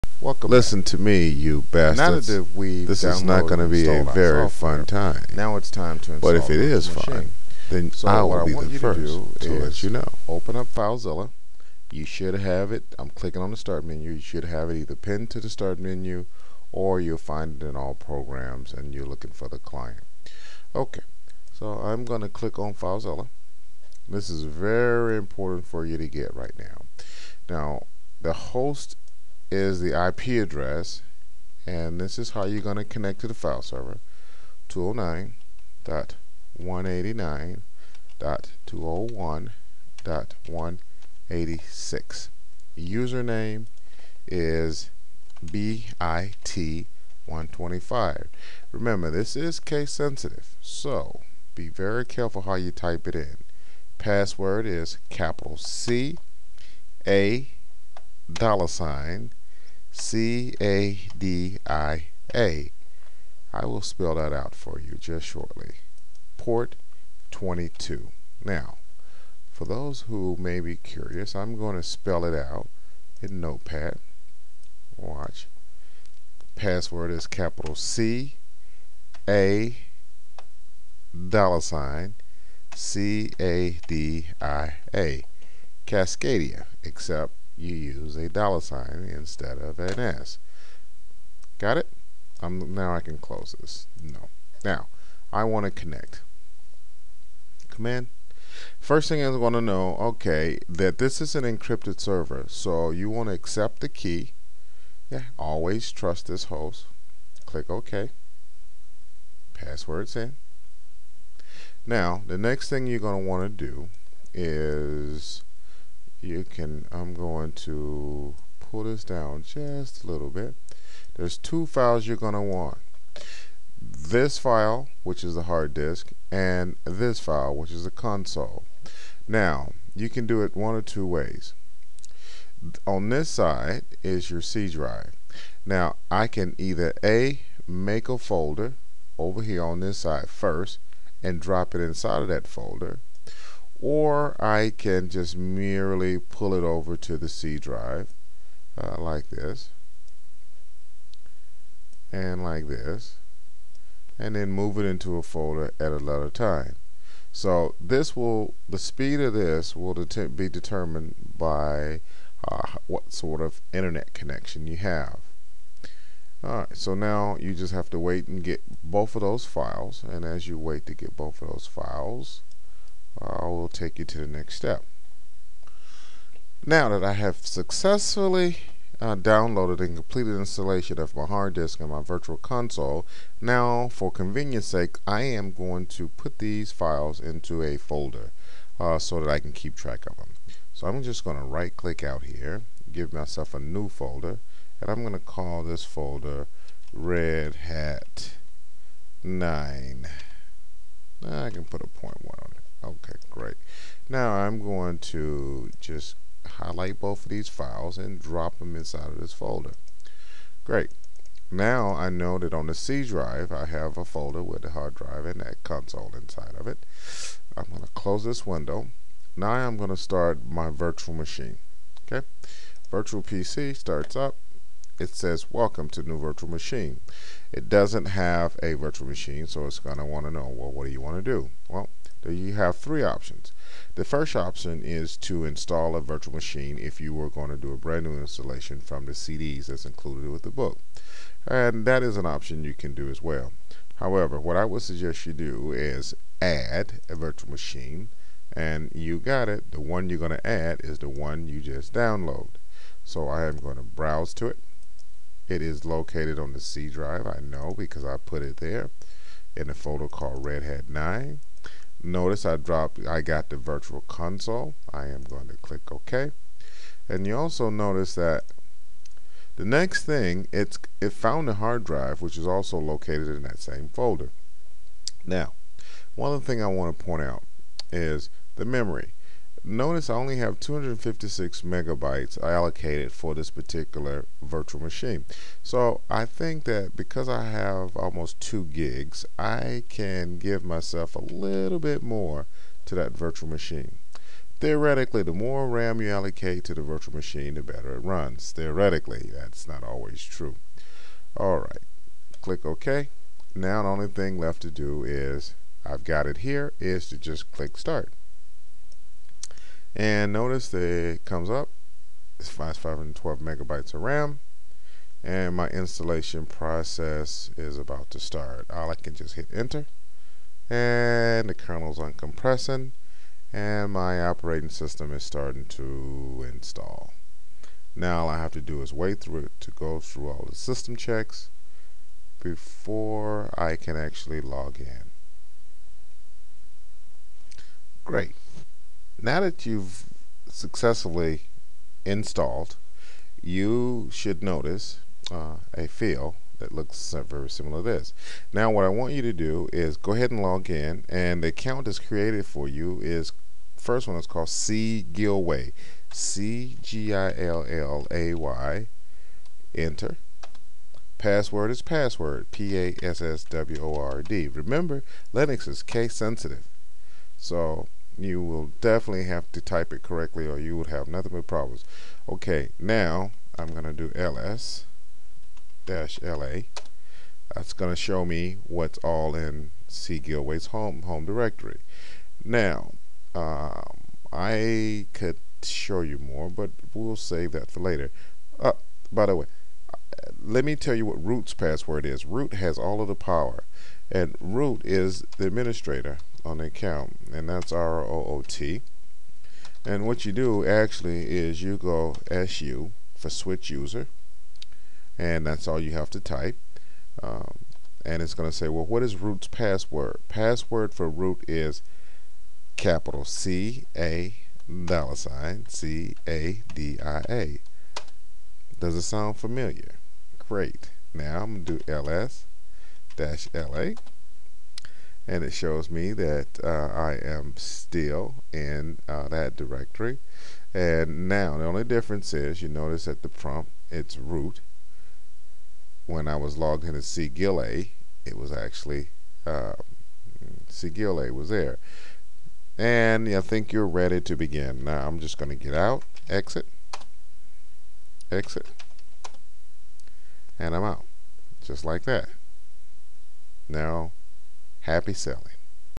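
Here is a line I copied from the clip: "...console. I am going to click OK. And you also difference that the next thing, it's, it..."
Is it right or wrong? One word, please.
wrong.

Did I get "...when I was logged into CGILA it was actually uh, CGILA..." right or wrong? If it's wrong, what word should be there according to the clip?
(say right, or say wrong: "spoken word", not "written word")
right.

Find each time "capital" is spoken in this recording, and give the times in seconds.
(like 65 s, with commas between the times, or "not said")
55 s, 77 s, 412 s.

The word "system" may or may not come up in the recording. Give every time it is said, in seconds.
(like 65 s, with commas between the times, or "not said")
324 s, 330 s.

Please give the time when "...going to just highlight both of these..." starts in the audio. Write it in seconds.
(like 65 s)
204 s.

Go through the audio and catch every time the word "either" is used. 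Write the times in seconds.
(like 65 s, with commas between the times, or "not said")
14 s, 136 s.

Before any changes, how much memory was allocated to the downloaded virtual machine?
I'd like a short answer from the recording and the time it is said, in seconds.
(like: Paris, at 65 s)
256 megabytes, at 280 s.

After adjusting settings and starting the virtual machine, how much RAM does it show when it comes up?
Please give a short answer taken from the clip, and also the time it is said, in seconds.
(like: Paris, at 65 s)
512 megabytes, at 312 s.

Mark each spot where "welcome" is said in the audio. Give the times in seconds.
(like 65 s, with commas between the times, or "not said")
0 s, 225 s.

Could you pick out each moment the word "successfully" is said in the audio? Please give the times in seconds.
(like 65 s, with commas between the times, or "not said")
177 s, 340 s.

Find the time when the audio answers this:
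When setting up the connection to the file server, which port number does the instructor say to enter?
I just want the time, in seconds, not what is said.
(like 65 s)
66 s.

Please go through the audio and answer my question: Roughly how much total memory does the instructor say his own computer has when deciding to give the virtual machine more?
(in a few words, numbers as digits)
almost 2 gigs.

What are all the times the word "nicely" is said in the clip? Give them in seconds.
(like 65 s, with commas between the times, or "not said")
not said.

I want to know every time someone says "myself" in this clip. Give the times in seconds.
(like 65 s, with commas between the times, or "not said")
193 s, 290 s.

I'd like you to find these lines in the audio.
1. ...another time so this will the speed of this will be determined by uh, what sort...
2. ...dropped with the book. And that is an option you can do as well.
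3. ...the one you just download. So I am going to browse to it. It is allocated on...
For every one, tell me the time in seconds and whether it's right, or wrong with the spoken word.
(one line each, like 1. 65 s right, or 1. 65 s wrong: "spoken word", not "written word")
1. 155 s right
2. 239 s wrong: "included", not "dropped"
3. 250 s wrong: "located", not "allocated".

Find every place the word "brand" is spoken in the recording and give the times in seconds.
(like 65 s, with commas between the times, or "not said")
237 s.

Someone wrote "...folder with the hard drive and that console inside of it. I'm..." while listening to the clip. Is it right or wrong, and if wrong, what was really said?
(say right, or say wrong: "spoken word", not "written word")
right.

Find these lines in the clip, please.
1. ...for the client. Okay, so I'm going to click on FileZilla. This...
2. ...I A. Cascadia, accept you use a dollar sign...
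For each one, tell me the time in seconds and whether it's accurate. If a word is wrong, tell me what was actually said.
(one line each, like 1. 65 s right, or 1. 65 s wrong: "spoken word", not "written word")
1. 19 s right
2. 84 s wrong: "except", not "accept".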